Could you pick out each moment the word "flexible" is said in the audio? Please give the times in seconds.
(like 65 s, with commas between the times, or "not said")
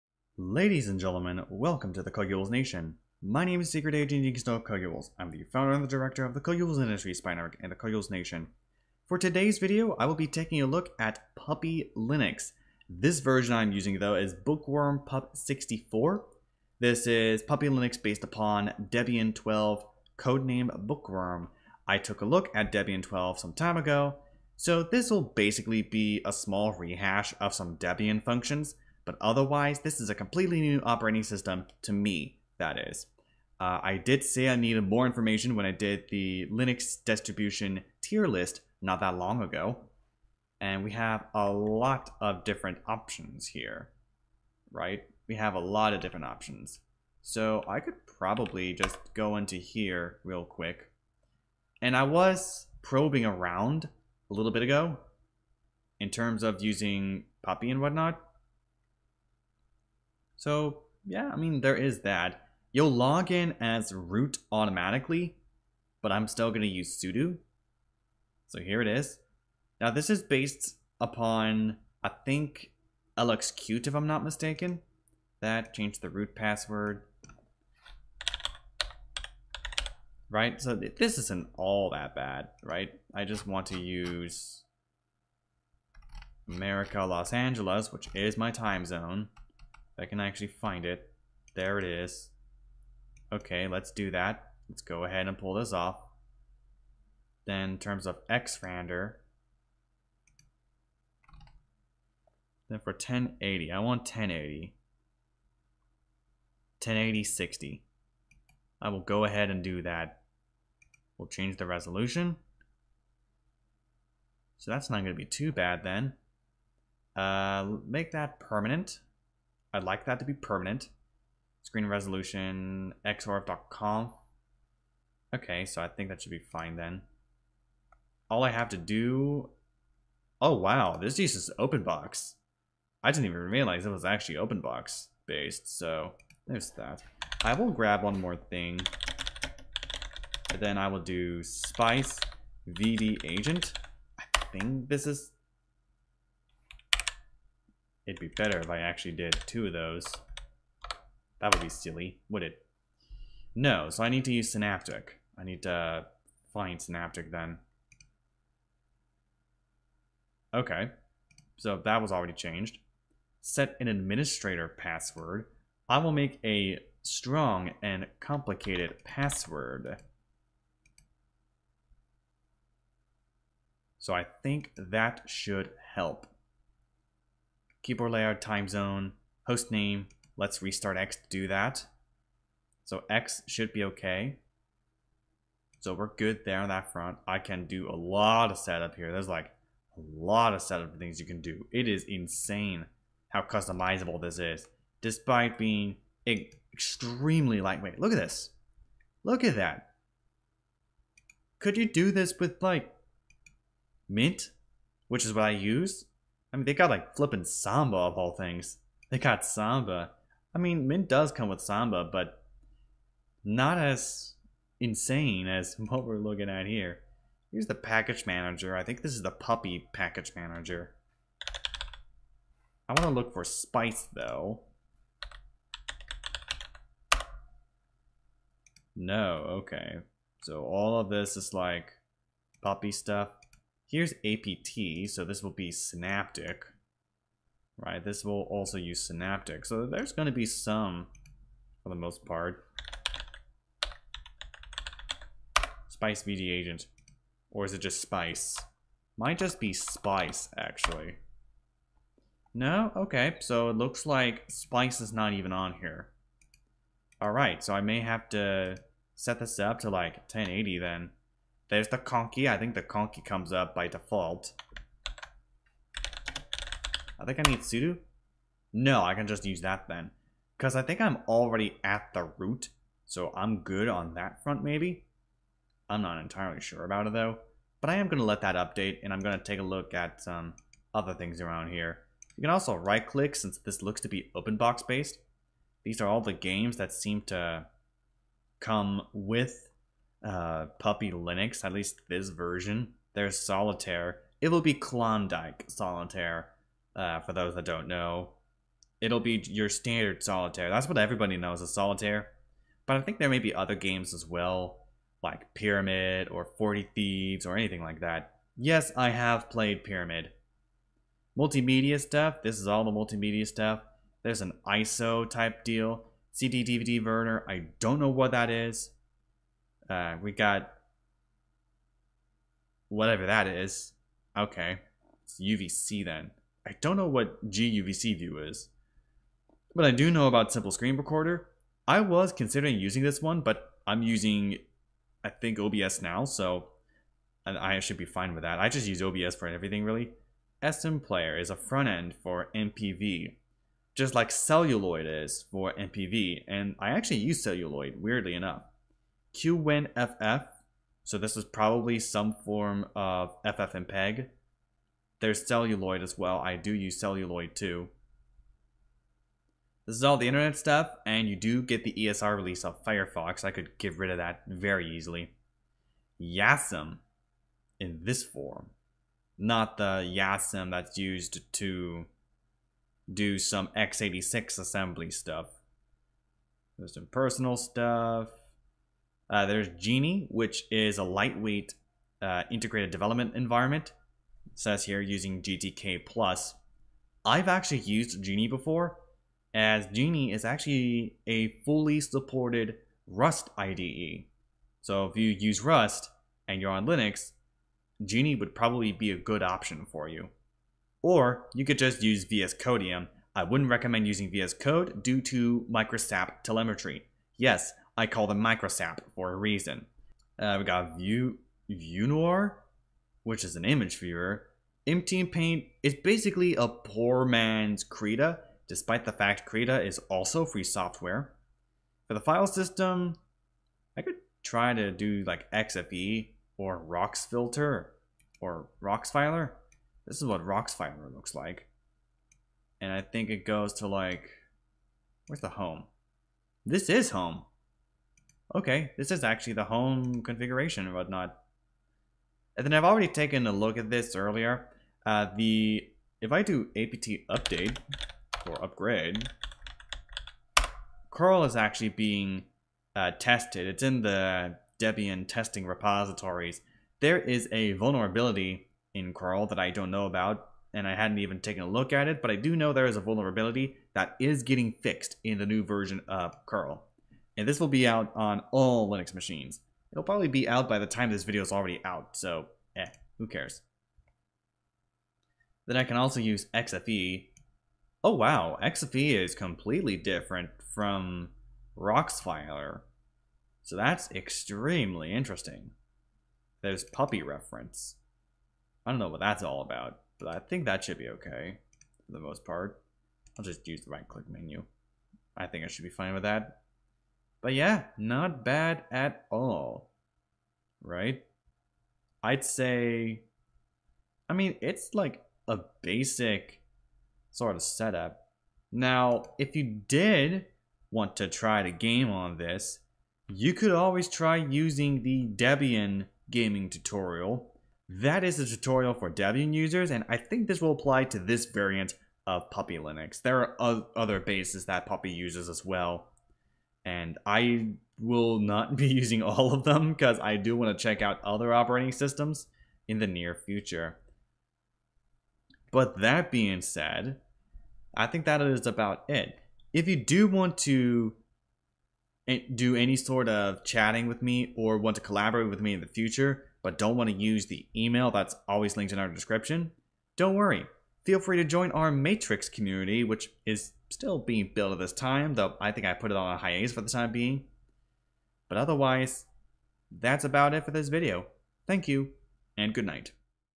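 not said.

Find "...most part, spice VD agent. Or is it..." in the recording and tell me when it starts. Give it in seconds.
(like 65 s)
241 s.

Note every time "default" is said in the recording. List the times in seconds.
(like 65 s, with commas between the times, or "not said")
263 s.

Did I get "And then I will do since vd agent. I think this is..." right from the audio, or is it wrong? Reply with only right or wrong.
wrong.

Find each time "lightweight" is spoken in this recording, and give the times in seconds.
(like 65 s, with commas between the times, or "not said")
197 s, 381 s.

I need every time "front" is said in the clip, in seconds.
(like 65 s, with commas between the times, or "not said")
186 s, 274 s, 341 s.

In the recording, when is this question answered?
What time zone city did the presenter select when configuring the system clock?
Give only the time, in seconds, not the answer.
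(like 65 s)
87 s.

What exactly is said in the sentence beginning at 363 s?
I could get rid of that very easily.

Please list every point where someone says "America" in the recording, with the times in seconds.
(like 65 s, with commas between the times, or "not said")
86 s.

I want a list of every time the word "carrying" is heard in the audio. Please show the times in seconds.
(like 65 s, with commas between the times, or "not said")
not said.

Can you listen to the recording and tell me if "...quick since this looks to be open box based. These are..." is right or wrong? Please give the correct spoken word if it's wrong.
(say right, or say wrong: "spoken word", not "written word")
wrong: "click", not "quick".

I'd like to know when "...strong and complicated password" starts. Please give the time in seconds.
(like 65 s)
167 s.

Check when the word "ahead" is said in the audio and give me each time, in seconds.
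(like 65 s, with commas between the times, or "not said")
95 s, 109 s.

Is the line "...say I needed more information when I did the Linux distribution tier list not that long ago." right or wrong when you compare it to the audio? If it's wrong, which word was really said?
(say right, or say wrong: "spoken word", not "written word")
right.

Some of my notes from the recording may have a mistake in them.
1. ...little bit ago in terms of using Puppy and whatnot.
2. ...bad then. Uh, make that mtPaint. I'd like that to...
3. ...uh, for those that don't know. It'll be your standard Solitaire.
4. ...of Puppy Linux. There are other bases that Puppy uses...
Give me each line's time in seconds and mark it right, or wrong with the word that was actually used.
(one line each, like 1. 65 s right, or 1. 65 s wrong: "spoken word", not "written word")
1. 54 s right
2. 115 s wrong: "permanent", not "mtPaint"
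3. 296 s right
4. 522 s right.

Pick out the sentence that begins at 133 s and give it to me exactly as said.
I didn't even realize it was actually OpenBox based, so there's that.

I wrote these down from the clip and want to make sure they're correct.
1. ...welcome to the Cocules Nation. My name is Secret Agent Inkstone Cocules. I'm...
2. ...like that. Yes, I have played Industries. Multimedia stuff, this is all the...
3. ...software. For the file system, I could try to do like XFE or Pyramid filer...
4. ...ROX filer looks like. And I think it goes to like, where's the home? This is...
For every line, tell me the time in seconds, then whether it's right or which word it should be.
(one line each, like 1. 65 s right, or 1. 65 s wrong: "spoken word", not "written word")
1. 1 s right
2. 307 s wrong: "Pyramid", not "Industries"
3. 420 s wrong: "ROX", not "Pyramid"
4. 430 s right.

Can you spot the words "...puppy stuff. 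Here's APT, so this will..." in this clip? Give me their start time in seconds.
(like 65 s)
232 s.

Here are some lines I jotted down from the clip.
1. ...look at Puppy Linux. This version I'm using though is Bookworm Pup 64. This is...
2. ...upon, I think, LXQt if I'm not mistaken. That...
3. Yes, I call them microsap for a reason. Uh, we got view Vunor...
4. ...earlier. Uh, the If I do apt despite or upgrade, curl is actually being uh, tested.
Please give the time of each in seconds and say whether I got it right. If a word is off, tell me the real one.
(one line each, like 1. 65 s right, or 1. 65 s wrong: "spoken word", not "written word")
1. 10 s right
2. 70 s right
3. 407 s right
4. 444 s wrong: "update", not "despite".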